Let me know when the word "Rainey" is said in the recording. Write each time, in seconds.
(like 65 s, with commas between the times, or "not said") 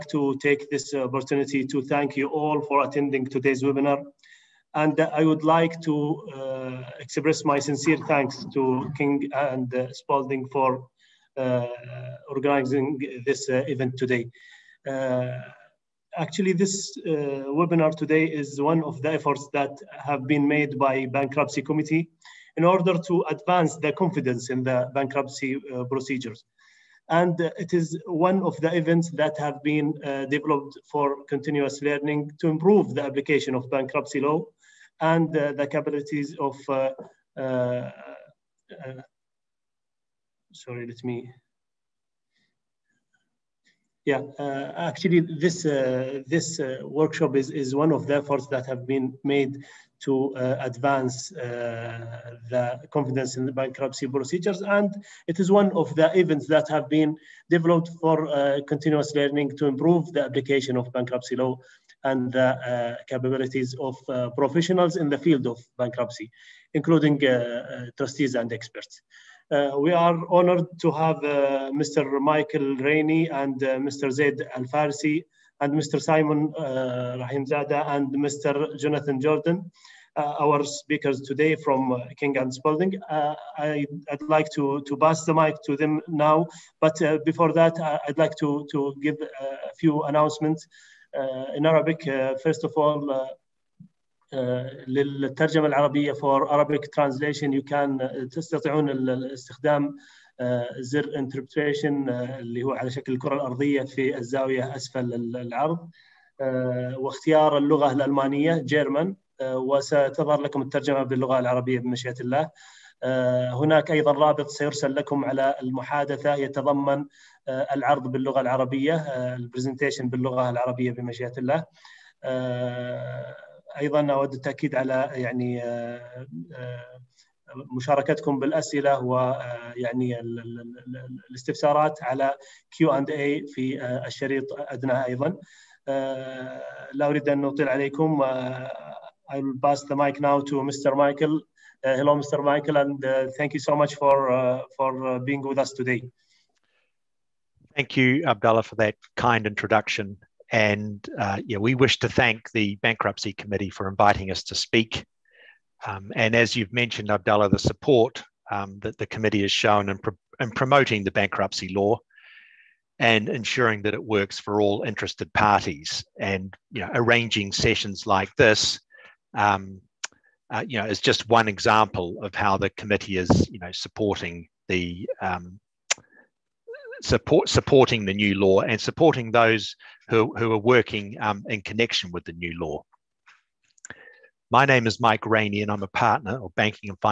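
72 s, 185 s.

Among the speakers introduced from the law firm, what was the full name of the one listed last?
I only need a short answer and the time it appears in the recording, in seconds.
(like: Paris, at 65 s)
Jonathan Jordan, at 78 s.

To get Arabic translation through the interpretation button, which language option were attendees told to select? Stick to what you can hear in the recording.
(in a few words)
German.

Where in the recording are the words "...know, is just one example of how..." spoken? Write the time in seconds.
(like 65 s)
170 s.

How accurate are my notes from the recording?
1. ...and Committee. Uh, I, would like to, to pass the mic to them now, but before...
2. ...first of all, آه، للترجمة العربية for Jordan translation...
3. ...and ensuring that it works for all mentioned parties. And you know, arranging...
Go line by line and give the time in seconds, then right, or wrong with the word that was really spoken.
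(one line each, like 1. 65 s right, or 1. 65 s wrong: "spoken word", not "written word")
1. 82 s wrong: "Spalding", not "Committee"
2. 92 s wrong: "Arabic", not "Jordan"
3. 162 s wrong: "interested", not "mentioned".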